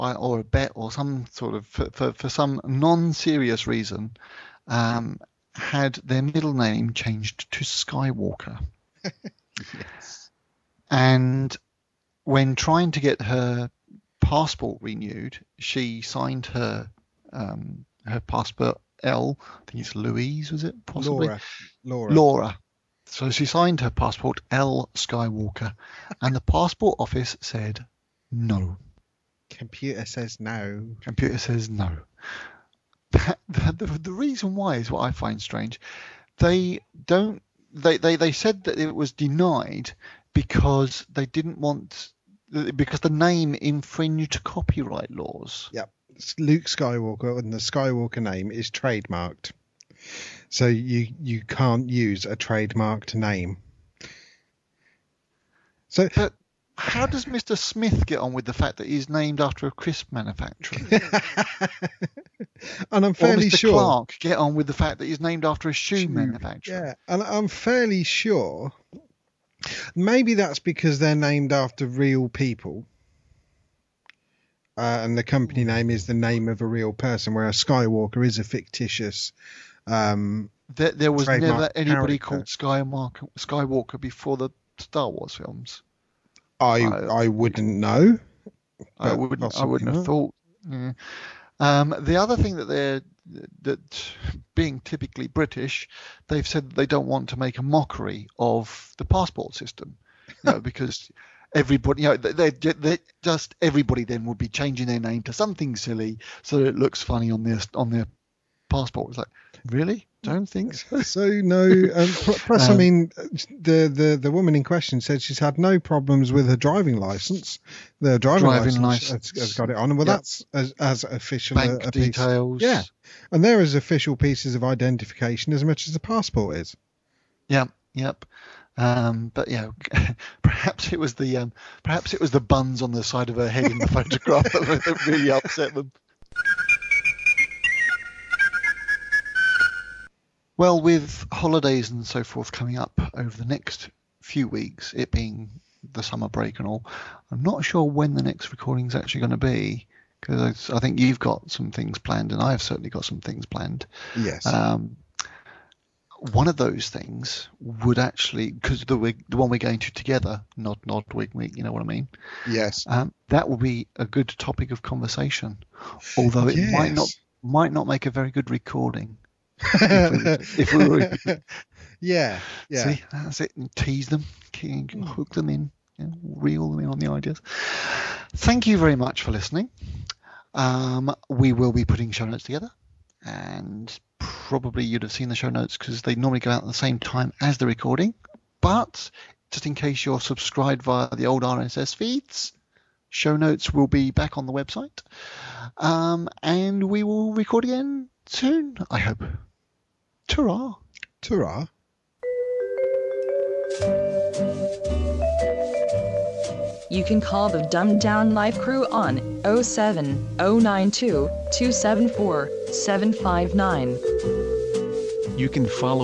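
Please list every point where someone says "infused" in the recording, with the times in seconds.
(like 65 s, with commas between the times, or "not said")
not said.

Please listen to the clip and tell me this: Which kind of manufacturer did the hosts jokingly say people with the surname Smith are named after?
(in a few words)
A crisp manufacturer.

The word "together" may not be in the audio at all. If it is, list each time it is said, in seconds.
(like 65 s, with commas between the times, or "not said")
159 s, 182 s.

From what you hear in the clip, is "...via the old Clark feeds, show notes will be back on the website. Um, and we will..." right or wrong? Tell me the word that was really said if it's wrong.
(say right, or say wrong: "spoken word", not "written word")
wrong: "RSS", not "Clark".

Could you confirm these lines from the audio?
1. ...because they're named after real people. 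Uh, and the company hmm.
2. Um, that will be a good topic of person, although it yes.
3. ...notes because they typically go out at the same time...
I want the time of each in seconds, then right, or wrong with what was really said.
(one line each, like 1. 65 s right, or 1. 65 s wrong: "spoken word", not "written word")
1. 70 s right
2. 162 s wrong: "conversation", not "person"
3. 185 s wrong: "normally", not "typically".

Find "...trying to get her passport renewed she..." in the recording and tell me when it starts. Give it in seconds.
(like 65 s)
12 s.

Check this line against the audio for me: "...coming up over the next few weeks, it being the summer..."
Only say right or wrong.
right.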